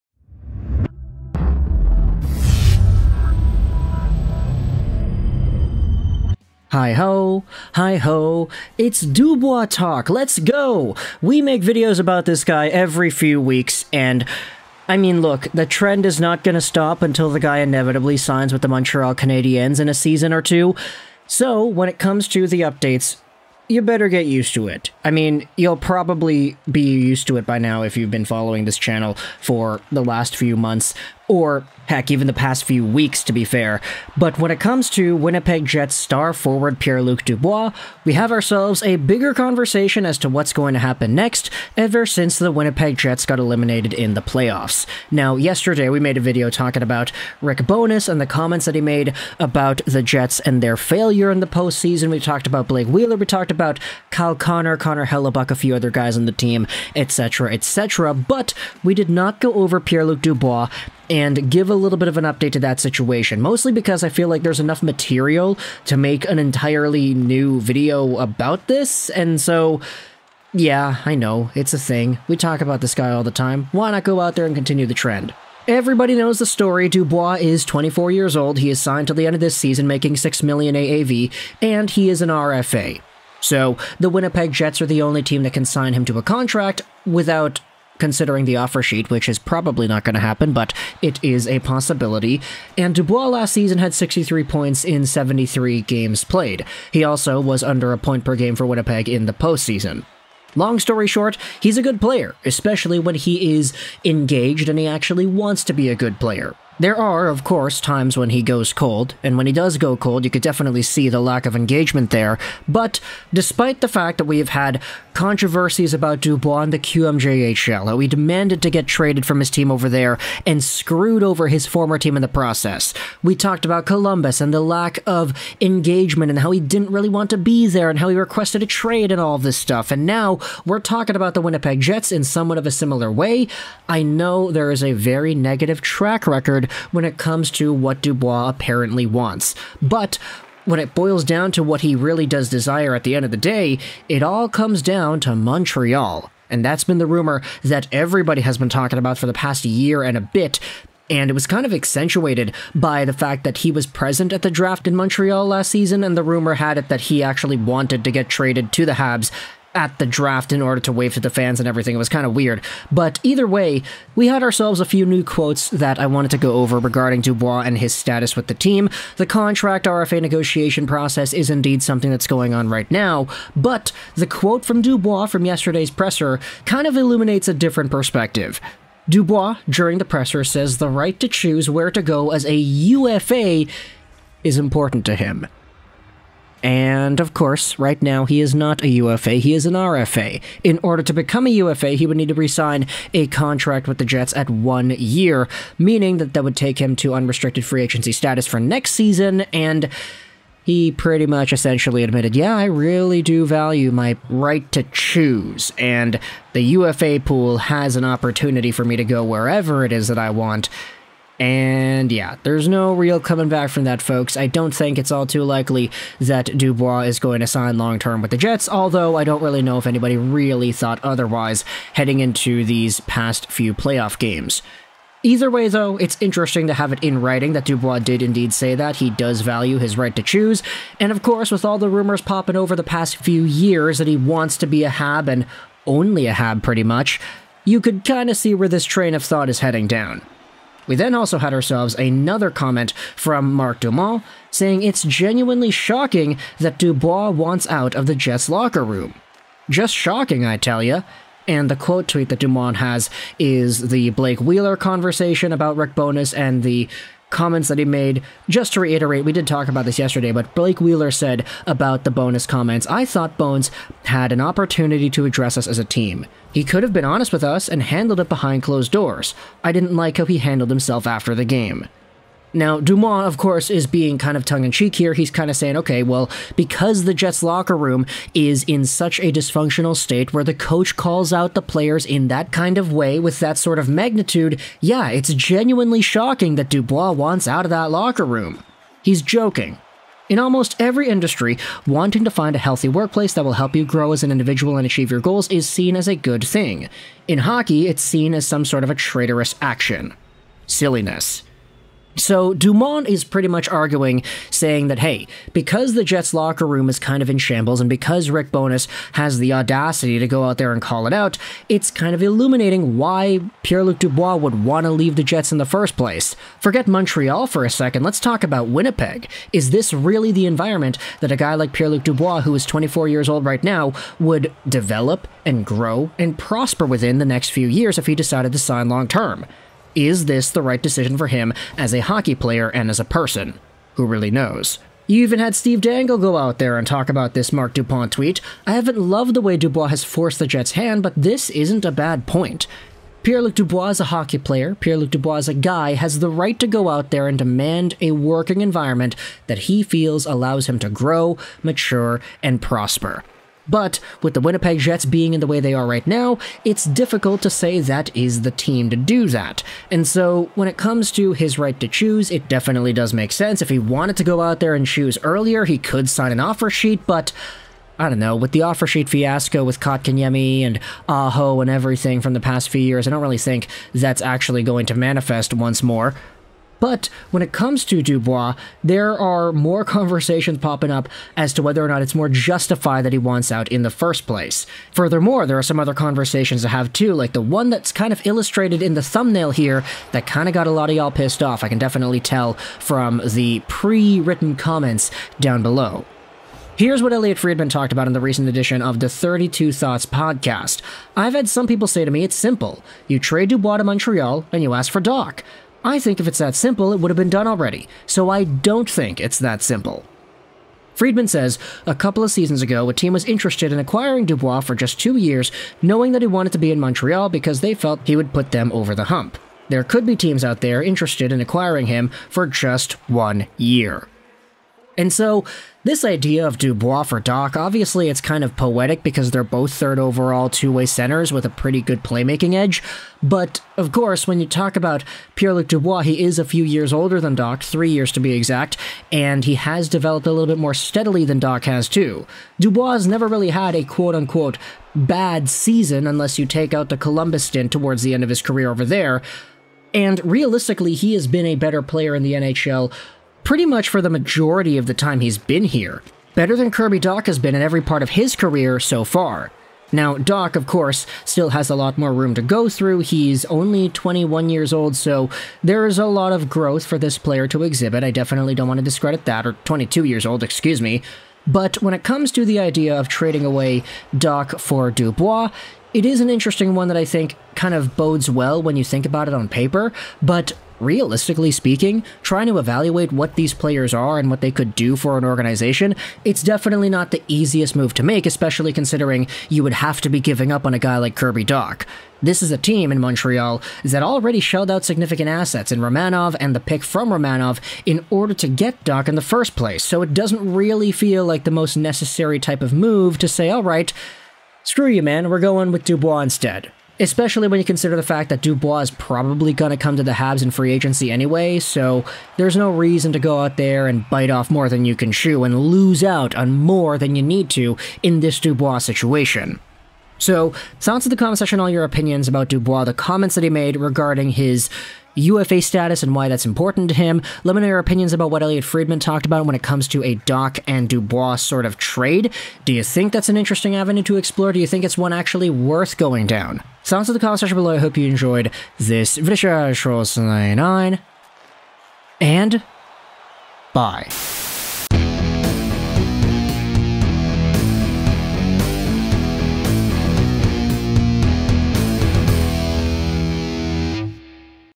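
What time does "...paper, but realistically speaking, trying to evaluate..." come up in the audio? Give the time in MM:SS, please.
07:59.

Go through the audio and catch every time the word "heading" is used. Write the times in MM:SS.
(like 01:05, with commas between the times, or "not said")
03:41, 03:59.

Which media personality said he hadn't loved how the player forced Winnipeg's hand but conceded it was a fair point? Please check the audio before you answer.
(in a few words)
Steve Dangle.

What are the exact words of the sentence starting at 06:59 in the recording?
There could be teams out there interested in acquiring him for just one year.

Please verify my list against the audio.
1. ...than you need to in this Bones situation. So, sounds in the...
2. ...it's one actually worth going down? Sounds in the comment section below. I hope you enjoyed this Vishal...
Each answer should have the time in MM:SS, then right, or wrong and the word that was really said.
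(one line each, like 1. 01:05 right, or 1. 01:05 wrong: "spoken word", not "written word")
1. 08:36 wrong: "Dubois", not "Bones"
2. 08:54 right.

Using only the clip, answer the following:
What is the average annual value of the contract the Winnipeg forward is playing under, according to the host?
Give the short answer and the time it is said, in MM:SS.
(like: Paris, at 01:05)
6 million, at 01:20.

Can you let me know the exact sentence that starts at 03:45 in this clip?
Either way, though, it's interesting to have it in writing that Dubois did indeed say that.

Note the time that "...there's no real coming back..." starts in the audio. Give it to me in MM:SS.
03:32.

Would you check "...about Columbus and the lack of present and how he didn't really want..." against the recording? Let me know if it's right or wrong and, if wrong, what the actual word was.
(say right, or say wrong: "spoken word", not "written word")
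wrong: "engagement", not "present".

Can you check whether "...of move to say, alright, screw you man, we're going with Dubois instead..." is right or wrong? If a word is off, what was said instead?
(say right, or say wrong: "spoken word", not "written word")
right.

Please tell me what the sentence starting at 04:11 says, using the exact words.
And the quote tweet that Dumont has is the Blake Wheeler conversation about Rick Bowness and the comments that he made.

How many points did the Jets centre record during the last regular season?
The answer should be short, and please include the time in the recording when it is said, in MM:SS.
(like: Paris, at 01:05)
63, at 01:33.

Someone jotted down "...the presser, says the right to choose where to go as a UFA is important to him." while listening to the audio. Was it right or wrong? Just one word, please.
right.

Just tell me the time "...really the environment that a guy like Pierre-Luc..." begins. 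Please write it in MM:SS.
05:19.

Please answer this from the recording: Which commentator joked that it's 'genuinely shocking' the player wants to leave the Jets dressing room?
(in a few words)
Marc Dumont.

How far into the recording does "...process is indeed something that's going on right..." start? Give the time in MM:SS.
02:50.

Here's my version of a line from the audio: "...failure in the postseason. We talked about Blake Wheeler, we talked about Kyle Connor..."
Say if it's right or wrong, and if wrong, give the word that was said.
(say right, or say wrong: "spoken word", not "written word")
right.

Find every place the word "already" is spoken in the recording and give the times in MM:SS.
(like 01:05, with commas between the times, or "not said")
06:47, 08:14.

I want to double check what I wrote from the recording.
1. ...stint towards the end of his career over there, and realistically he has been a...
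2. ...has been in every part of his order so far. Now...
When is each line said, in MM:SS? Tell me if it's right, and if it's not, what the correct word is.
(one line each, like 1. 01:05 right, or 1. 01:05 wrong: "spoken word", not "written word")
1. 07:27 right
2. 07:37 wrong: "career", not "order".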